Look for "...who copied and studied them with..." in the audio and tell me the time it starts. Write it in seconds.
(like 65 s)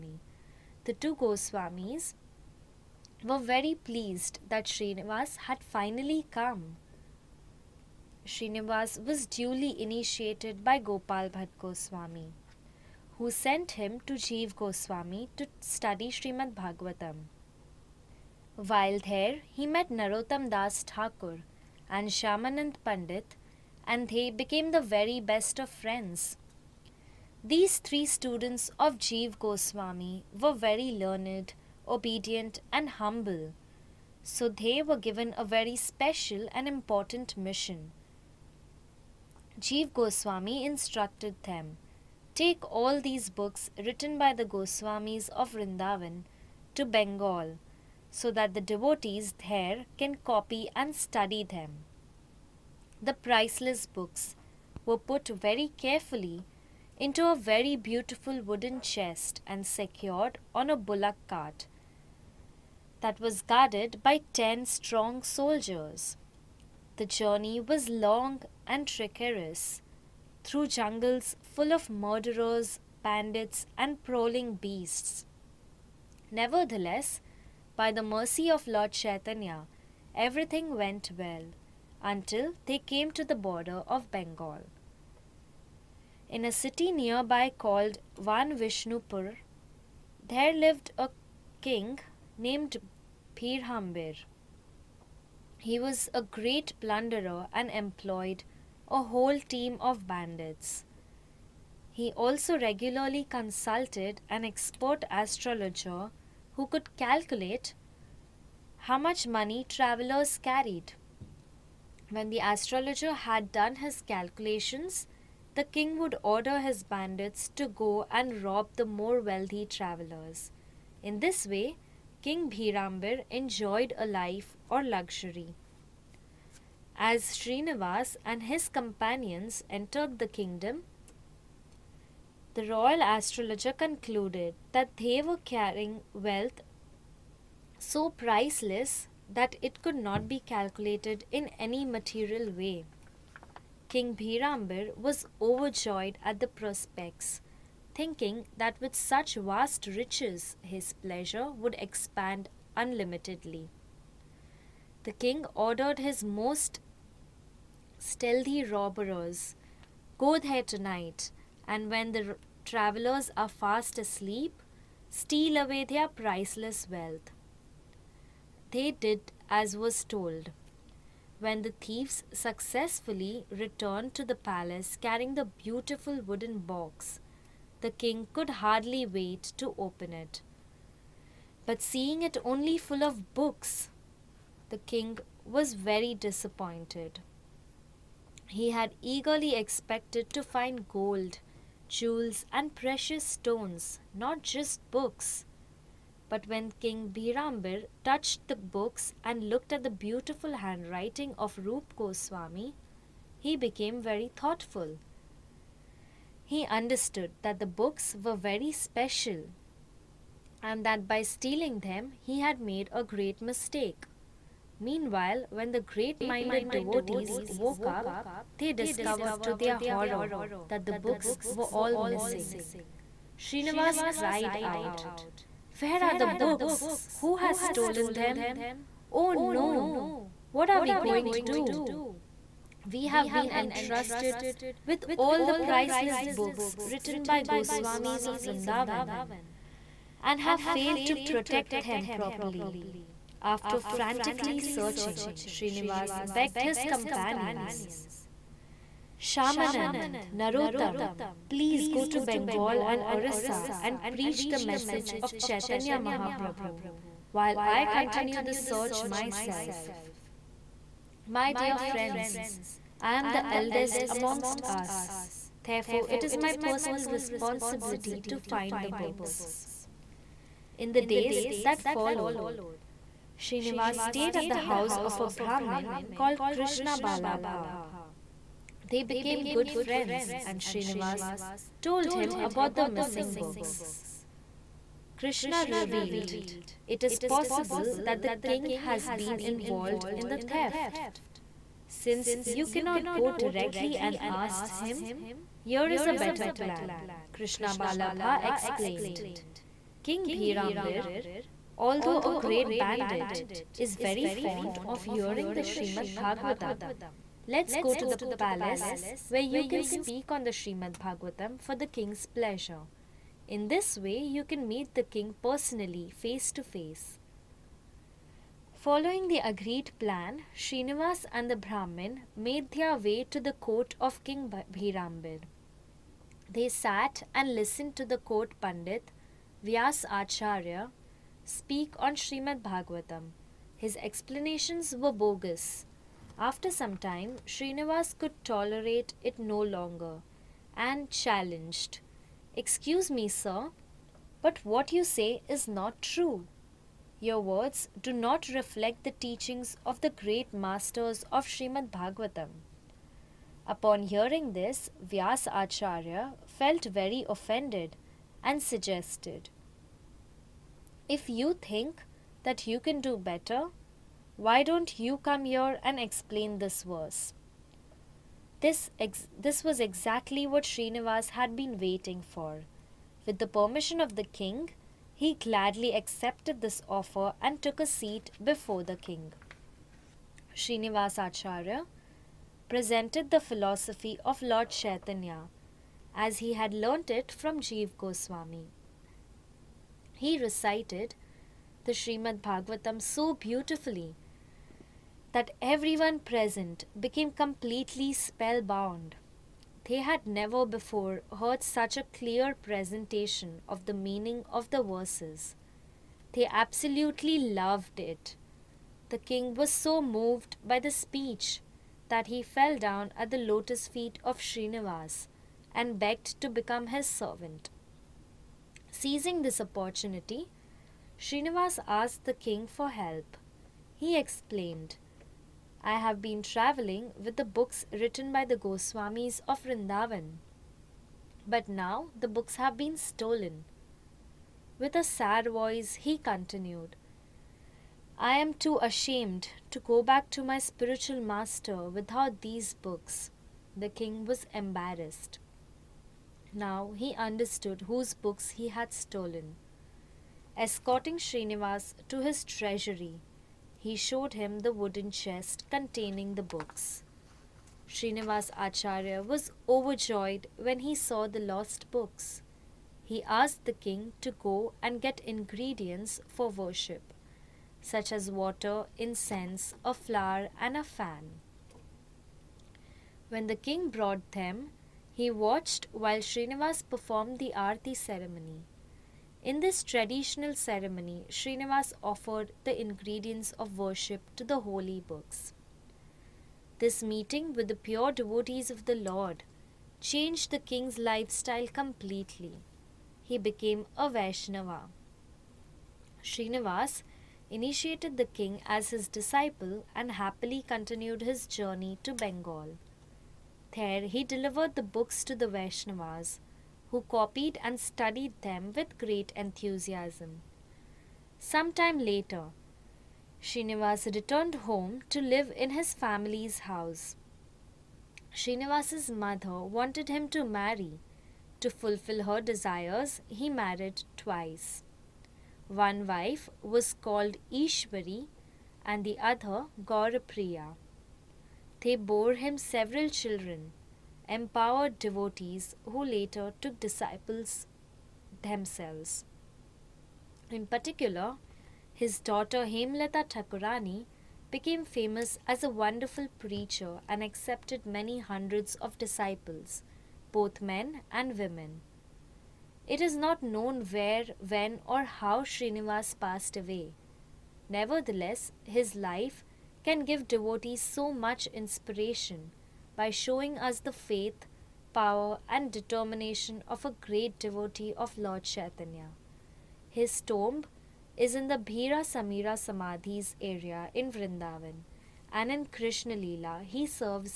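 506 s.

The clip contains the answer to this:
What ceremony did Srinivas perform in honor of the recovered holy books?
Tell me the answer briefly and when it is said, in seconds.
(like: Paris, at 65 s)
Aarti, at 477 s.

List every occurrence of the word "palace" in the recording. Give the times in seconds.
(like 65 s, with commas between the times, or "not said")
174 s, 308 s.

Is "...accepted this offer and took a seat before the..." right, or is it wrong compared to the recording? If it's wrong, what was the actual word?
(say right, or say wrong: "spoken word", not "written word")
right.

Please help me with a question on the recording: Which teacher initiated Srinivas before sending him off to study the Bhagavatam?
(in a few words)
Gopal Bhatt Goswami.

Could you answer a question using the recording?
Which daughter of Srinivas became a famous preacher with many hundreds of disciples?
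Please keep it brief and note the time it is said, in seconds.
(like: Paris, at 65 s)
Hemlata Thakurani, at 542 s.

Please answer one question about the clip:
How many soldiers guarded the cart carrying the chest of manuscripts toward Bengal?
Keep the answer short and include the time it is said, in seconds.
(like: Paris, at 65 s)
10, at 64 s.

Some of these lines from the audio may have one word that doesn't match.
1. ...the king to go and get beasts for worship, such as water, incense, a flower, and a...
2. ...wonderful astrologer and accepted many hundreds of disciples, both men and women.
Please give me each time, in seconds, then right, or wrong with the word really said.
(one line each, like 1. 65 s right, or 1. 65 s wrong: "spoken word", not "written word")
1. 463 s wrong: "ingredients", not "beasts"
2. 545 s wrong: "preacher", not "astrologer".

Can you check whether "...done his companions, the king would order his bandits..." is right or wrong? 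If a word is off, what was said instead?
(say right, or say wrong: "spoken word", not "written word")
wrong: "calculations", not "companions".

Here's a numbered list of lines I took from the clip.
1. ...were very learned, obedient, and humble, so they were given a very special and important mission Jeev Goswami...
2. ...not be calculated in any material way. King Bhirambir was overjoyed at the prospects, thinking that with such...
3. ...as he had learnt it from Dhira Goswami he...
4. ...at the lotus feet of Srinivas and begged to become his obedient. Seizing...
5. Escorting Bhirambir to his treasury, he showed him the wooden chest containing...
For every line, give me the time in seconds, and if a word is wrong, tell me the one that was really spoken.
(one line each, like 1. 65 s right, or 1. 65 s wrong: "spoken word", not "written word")
1. 30 s right
2. 139 s right
3. 386 s wrong: "Jeev", not "Dhira"
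4. 413 s wrong: "servant", not "obedient"
5. 450 s wrong: "Srinivas", not "Bhirambir".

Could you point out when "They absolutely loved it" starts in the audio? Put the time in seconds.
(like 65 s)
406 s.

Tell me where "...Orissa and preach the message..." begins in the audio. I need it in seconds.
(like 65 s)
253 s.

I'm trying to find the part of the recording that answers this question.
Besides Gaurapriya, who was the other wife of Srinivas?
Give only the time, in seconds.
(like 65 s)
527 s.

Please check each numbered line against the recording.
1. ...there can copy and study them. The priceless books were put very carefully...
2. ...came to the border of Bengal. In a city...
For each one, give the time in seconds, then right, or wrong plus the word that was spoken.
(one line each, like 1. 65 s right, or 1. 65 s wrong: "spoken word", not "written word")
1. 49 s right
2. 82 s right.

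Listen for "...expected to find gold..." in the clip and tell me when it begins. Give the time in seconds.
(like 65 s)
189 s.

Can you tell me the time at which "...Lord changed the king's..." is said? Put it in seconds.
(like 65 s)
488 s.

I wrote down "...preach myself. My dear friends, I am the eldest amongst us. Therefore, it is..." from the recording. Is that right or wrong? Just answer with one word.
wrong.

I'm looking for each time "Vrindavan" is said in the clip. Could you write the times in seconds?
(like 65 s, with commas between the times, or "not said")
45 s, 238 s, 429 s, 574 s.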